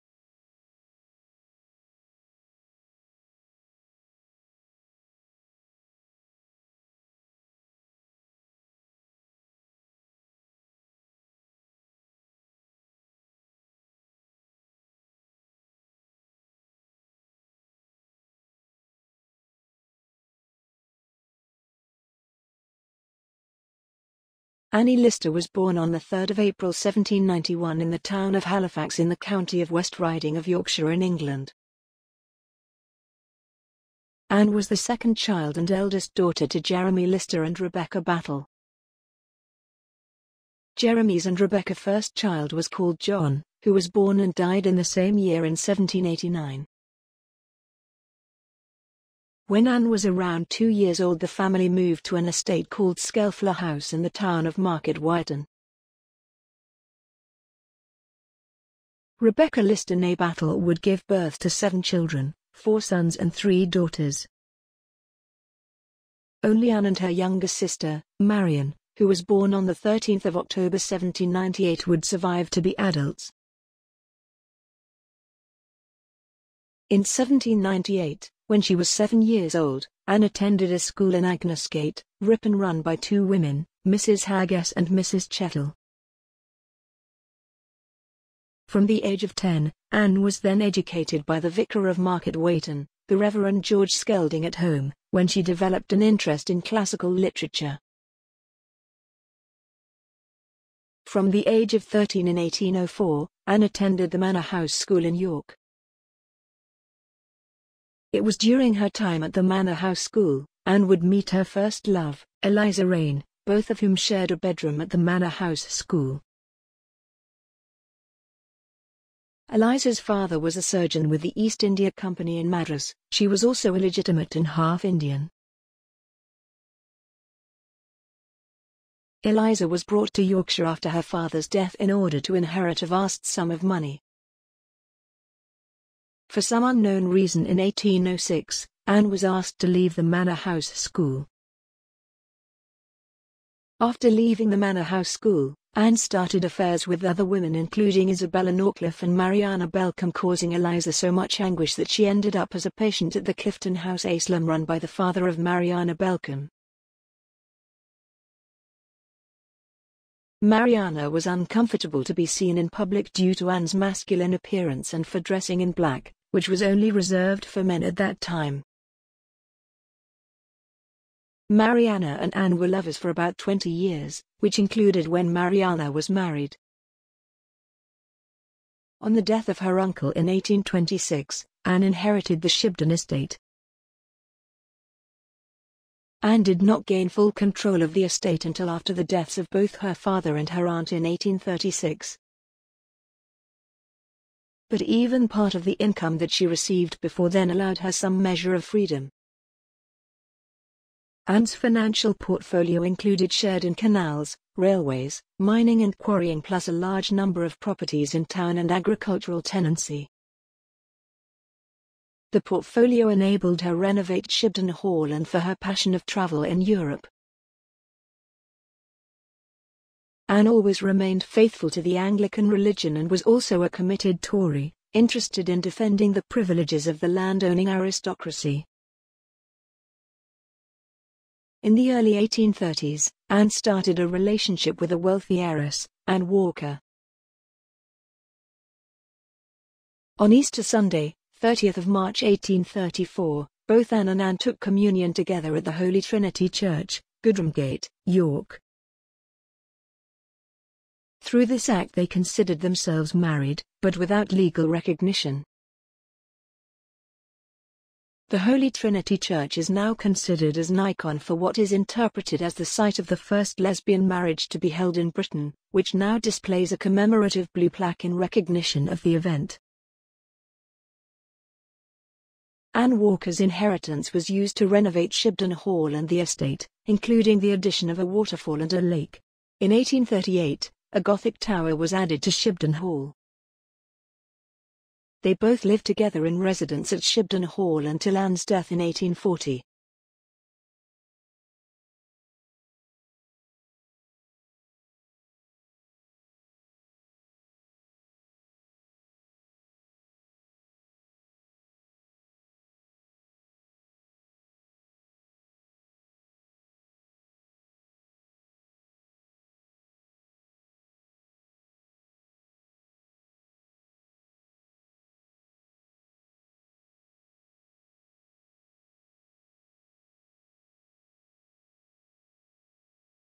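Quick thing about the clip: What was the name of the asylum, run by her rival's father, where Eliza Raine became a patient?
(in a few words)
Clifton House.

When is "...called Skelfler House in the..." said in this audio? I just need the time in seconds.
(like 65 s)
52 s.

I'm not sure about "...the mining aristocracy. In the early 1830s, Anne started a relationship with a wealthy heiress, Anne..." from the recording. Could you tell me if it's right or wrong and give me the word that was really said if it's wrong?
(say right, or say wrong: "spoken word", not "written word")
wrong: "landowning", not "mining".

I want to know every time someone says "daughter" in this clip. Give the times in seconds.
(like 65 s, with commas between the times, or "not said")
36 s, 63 s.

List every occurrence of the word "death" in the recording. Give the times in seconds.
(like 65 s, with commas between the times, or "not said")
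131 s, 179 s, 189 s, 288 s.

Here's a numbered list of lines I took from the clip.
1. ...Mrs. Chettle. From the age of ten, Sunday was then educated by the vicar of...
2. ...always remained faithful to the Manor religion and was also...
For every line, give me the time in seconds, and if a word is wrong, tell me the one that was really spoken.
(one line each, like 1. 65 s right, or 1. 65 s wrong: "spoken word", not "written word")
1. 84 s wrong: "Anne", not "Sunday"
2. 220 s wrong: "Anglican", not "Manor".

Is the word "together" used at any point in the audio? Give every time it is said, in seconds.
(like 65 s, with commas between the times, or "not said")
245 s, 285 s.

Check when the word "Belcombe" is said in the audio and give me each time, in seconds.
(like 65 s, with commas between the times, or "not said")
149 s, 155 s.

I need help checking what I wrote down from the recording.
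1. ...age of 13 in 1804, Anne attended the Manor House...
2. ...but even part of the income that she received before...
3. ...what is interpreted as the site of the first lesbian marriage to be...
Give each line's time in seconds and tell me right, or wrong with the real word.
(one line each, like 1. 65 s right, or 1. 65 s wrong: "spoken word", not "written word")
1. 101 s right
2. 194 s right
3. 261 s right.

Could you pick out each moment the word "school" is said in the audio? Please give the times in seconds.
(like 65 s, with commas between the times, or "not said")
80 s, 104 s, 110 s, 115 s, 140 s, 145 s.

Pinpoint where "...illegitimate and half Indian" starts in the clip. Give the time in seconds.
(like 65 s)
123 s.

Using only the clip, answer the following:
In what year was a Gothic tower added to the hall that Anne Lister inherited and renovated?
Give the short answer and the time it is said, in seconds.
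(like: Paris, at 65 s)
1838, at 279 s.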